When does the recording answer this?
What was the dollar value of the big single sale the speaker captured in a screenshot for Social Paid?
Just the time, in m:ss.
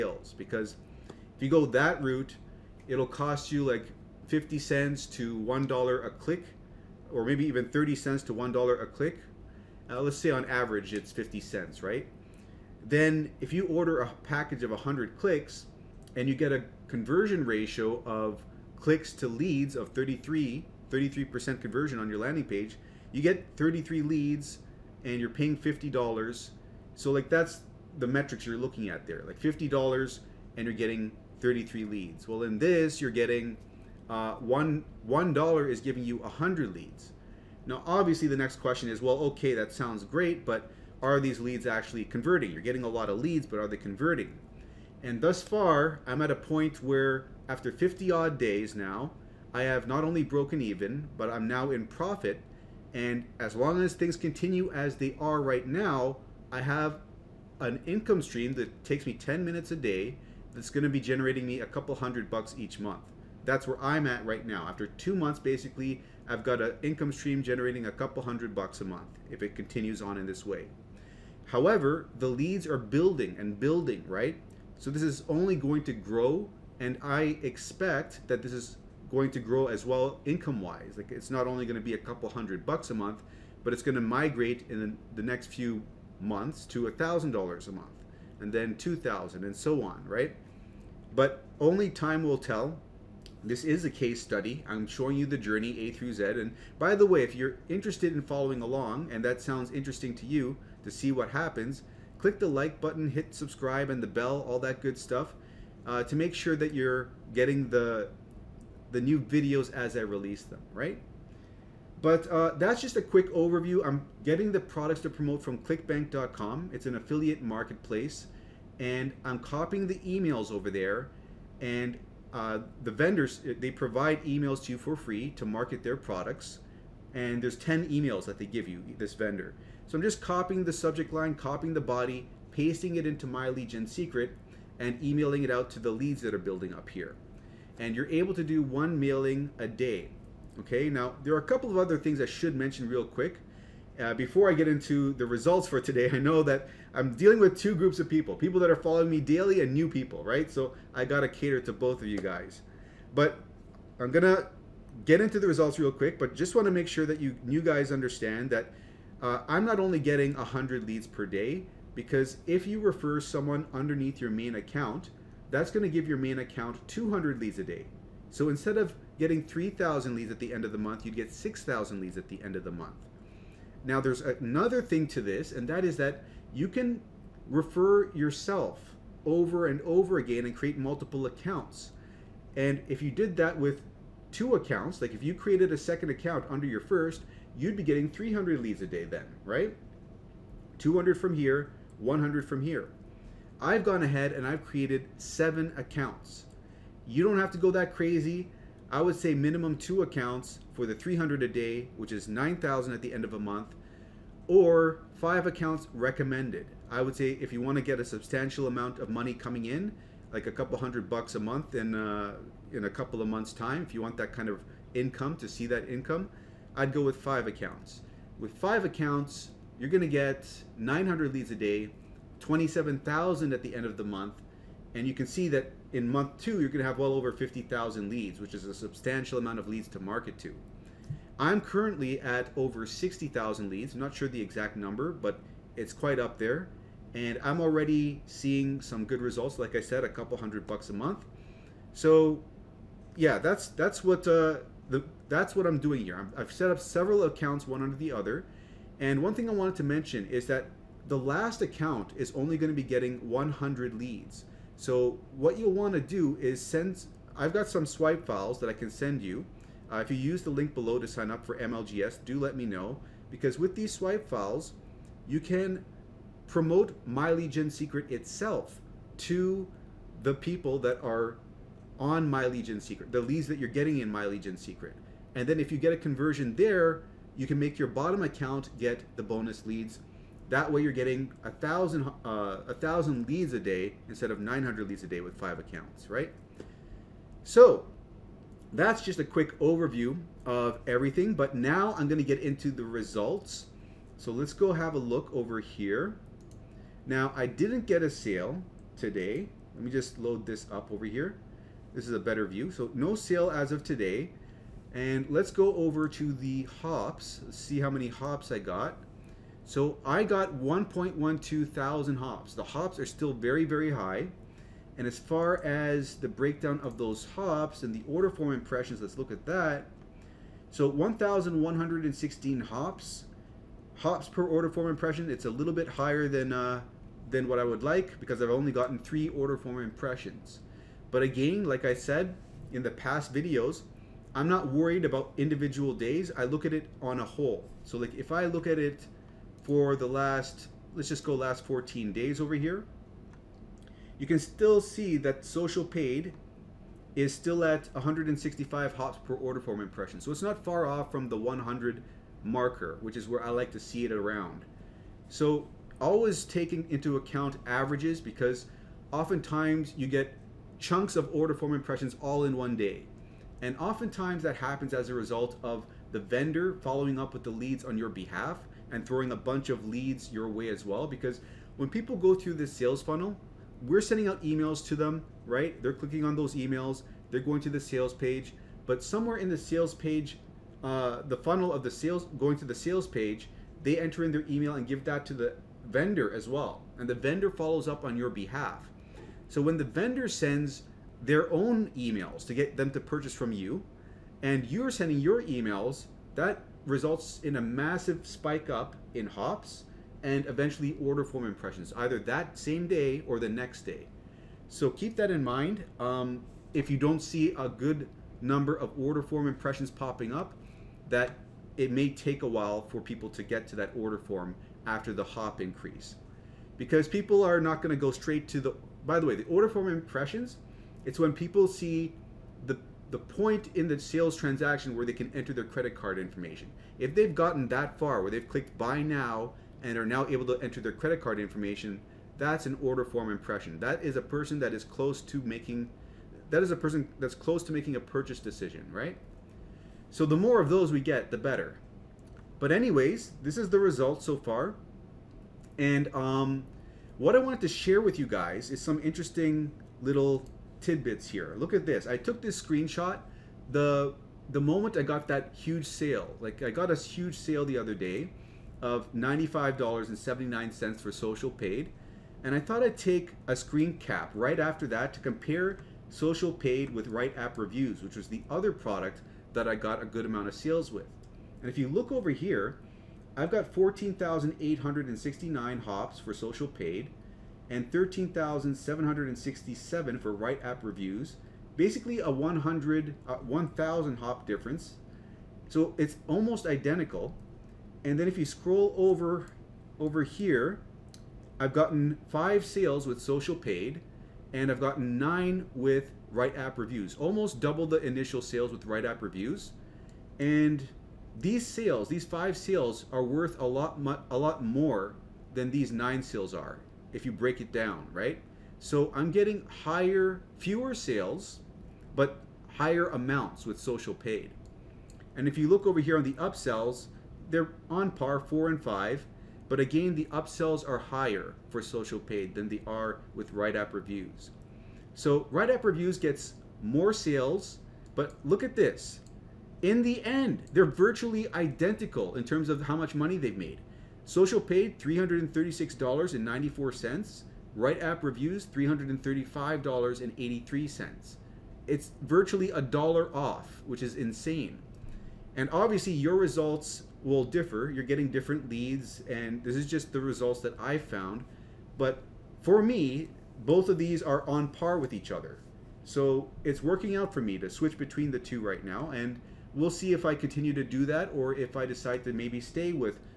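7:39.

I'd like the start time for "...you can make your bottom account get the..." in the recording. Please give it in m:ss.
4:37.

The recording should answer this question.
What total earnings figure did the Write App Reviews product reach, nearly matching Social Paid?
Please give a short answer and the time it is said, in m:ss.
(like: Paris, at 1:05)
$335.83, at 8:58.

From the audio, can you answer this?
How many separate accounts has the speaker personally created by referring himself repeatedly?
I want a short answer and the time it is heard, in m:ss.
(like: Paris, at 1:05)
7, at 3:15.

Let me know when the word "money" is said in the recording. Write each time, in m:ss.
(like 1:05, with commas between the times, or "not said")
3:29, 8:53.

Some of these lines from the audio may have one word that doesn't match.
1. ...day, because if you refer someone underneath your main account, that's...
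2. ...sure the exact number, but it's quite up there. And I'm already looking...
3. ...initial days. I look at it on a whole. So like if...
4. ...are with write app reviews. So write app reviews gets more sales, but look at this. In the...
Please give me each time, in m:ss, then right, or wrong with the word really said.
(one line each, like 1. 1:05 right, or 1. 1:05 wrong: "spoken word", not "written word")
1. 2:41 right
2. 3:54 wrong: "seeing", not "looking"
3. 5:35 wrong: "individual", not "initial"
4. 8:42 right.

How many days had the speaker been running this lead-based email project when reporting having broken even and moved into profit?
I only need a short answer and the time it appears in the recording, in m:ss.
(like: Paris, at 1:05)
50, at 0:47.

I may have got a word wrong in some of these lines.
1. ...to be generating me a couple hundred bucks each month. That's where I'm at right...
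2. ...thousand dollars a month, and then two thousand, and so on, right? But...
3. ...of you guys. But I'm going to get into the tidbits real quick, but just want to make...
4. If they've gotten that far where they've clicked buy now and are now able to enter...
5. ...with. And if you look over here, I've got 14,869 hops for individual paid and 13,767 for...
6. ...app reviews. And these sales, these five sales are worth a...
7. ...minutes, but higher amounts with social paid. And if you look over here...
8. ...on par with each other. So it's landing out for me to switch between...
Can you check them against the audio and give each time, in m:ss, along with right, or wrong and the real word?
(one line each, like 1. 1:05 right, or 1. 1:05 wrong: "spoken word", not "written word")
1. 1:00 right
2. 1:26 right
3. 2:32 wrong: "results", not "tidbits"
4. 7:06 right
5. 7:50 wrong: "social", not "individual"
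6. 8:19 right
7. 8:30 wrong: "sales", not "minutes"
8. 9:14 wrong: "working", not "landing".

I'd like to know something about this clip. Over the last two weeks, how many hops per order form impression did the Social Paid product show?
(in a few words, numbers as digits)
165.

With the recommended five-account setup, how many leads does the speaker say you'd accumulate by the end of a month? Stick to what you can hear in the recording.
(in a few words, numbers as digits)
27,000.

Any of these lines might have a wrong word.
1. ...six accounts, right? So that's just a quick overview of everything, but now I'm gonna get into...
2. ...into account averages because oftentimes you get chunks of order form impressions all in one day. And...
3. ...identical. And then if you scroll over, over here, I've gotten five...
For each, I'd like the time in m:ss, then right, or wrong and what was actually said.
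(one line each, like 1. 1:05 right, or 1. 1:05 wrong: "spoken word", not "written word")
1. 4:45 wrong: "five", not "six"
2. 5:56 right
3. 8:06 right.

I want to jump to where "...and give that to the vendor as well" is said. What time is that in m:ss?
6:24.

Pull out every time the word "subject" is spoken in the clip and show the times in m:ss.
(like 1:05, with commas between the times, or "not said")
2:10.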